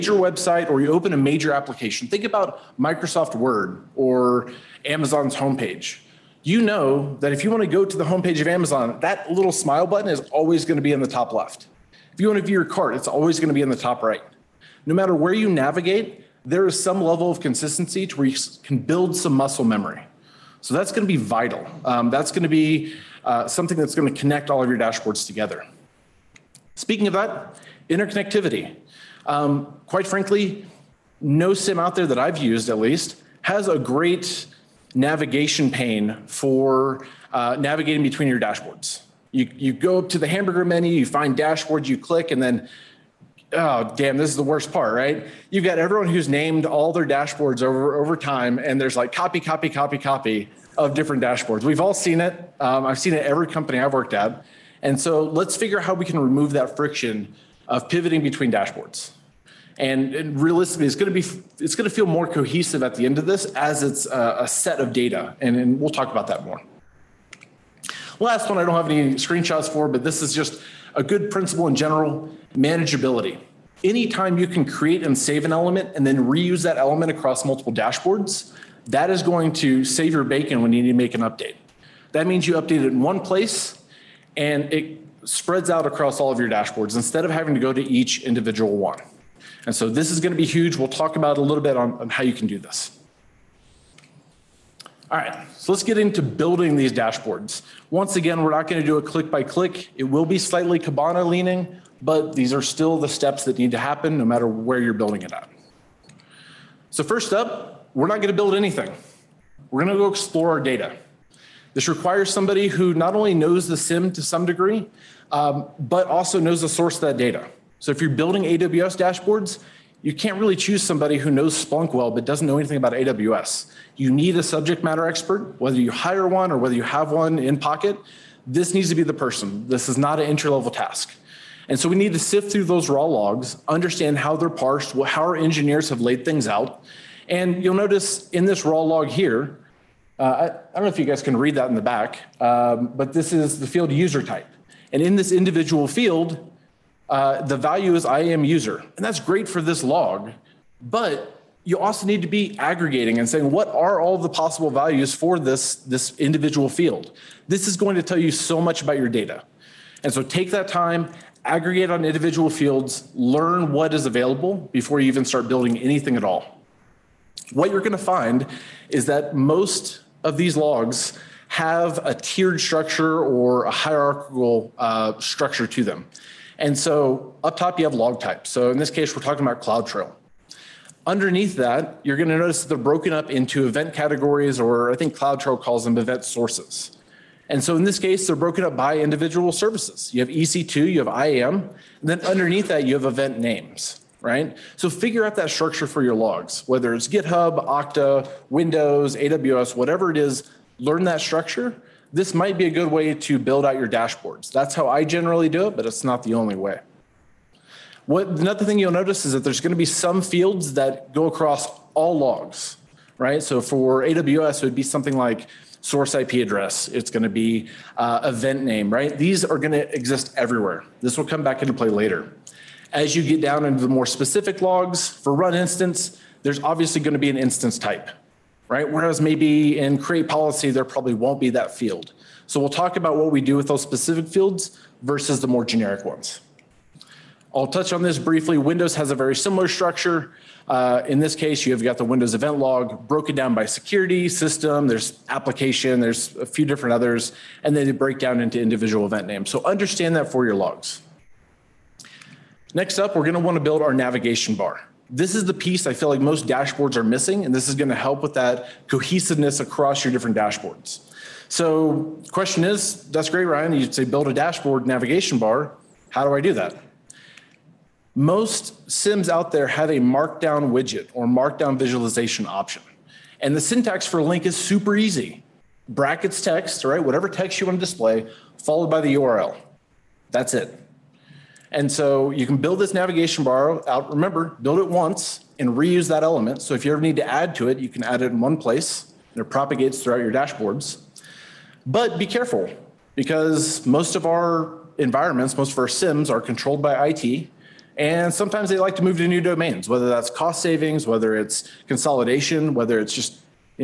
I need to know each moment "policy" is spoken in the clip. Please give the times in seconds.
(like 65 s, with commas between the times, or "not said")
230 s.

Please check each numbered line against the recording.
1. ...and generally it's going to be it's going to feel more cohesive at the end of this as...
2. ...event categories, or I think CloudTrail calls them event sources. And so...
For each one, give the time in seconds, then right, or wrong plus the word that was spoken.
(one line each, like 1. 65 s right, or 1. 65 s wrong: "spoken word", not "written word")
1. 60 s wrong: "realistically", not "generally"
2. 183 s right.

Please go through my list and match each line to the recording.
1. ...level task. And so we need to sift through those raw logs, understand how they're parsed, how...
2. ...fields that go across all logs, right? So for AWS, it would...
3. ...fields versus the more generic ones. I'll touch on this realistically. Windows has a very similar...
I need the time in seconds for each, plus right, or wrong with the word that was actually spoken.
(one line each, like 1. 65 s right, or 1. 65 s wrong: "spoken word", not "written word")
1. 130 s right
2. 210 s right
3. 234 s wrong: "briefly", not "realistically".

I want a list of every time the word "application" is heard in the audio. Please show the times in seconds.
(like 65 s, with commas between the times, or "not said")
1 s, 245 s.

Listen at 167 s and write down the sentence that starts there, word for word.
What you're going to find is that most of these logs have a tiered structure or a hierarchical uh, structure to them.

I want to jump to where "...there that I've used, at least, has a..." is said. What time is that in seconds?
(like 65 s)
31 s.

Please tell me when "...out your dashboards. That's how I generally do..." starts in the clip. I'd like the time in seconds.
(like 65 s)
203 s.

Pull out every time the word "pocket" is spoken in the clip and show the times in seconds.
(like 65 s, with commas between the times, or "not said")
127 s.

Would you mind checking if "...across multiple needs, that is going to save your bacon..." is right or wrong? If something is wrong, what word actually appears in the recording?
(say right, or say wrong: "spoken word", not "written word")
wrong: "dashboards", not "needs".